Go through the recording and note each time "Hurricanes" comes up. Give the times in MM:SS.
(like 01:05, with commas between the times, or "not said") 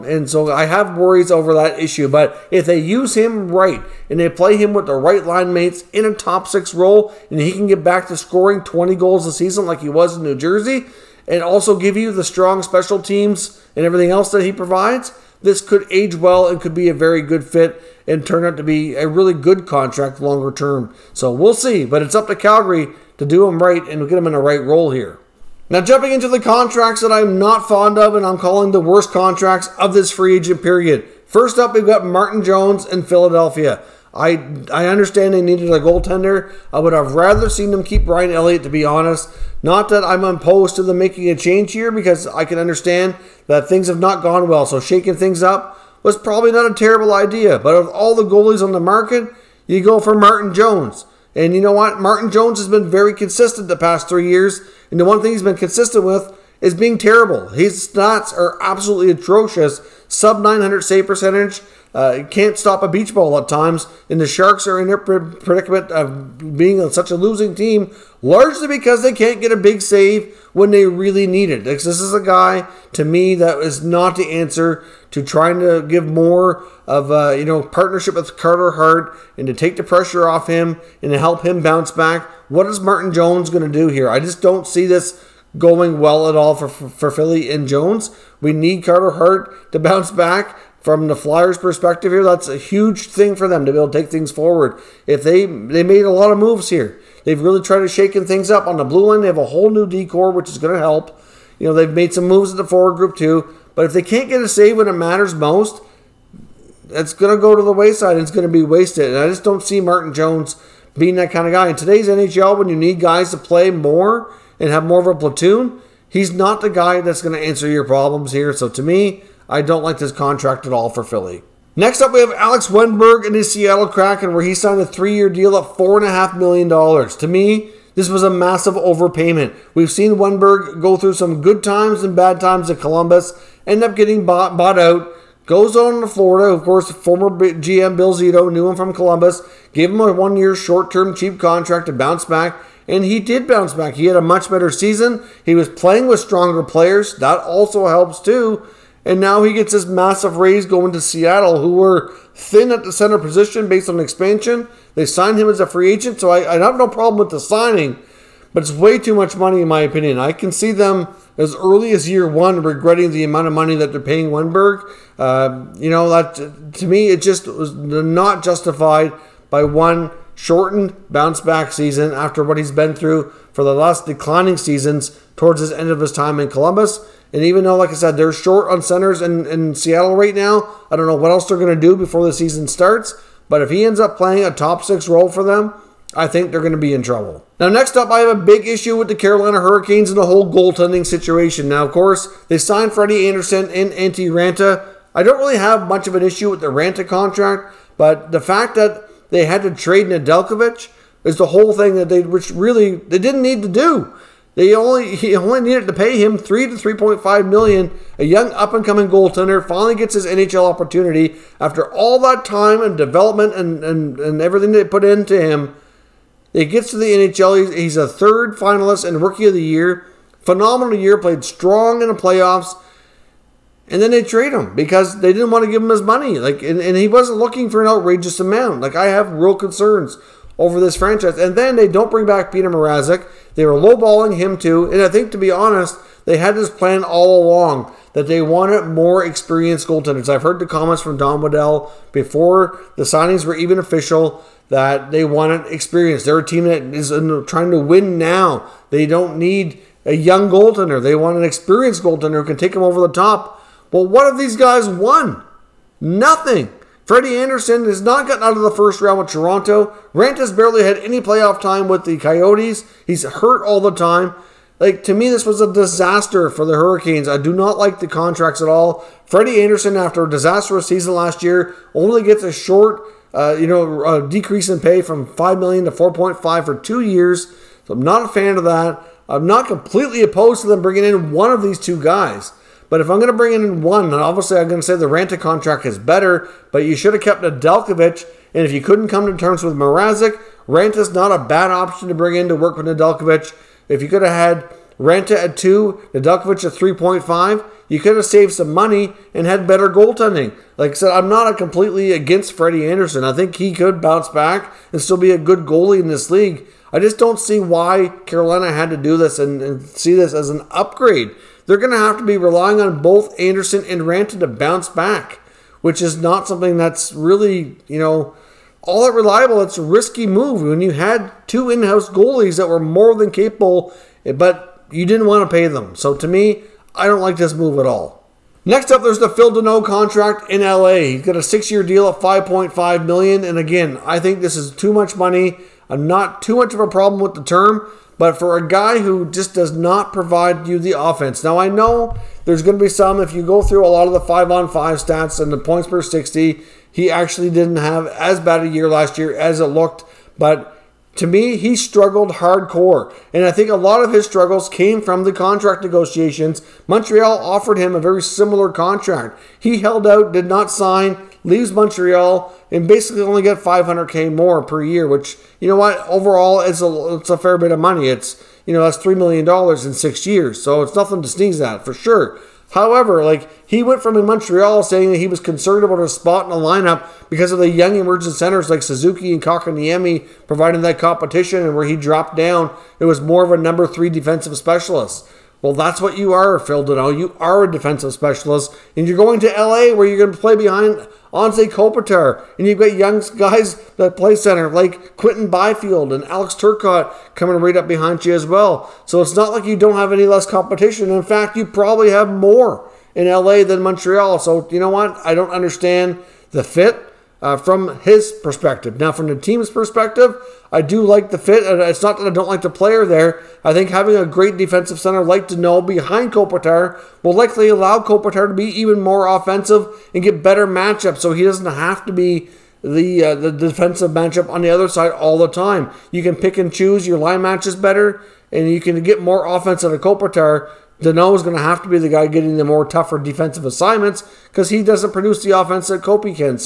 03:09, 04:26.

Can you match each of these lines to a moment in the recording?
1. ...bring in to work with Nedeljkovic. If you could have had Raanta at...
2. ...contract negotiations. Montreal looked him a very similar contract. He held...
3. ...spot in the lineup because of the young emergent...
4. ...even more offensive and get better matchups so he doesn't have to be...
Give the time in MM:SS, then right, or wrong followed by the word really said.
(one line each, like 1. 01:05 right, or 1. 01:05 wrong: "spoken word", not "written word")
1. 04:52 right
2. 05:55 wrong: "offered", not "looked"
3. 06:16 right
4. 06:58 right.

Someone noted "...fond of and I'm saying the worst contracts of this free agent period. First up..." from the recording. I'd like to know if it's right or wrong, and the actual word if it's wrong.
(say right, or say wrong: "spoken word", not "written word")
wrong: "calling", not "saying".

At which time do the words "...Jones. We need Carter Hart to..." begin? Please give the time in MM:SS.
01:27.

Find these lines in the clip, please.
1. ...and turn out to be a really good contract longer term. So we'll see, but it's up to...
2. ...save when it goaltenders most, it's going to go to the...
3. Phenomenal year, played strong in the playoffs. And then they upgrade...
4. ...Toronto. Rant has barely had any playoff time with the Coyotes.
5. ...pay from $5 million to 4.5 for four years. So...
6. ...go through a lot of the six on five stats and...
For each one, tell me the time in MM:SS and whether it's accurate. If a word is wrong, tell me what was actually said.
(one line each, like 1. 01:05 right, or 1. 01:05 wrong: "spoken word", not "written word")
1. 00:18 right
2. 01:44 wrong: "matters", not "goaltenders"
3. 03:40 wrong: "trade", not "upgrade"
4. 04:19 right
5. 04:34 wrong: "two", not "four"
6. 05:43 wrong: "five", not "six".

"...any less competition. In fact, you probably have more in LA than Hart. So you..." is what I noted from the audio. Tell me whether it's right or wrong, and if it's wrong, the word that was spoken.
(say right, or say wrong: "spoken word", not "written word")
wrong: "Montreal", not "Hart".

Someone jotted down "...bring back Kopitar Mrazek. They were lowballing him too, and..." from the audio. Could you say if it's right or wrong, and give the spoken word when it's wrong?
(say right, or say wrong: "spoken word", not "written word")
wrong: "Peter", not "Kopitar".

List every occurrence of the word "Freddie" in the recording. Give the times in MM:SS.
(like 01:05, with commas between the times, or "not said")
03:12, 04:17, 04:29, 05:02.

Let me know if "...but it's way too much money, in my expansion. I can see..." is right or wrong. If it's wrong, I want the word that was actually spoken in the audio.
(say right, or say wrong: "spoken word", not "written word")
wrong: "opinion", not "expansion".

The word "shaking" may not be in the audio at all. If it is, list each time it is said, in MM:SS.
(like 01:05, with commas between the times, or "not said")
00:44, 01:37.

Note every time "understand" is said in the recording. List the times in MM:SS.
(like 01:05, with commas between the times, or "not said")
00:34, 00:42, 06:45.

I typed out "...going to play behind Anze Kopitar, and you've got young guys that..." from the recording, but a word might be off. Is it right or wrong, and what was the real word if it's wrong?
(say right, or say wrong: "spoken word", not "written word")
right.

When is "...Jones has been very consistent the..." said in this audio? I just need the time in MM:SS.
00:52.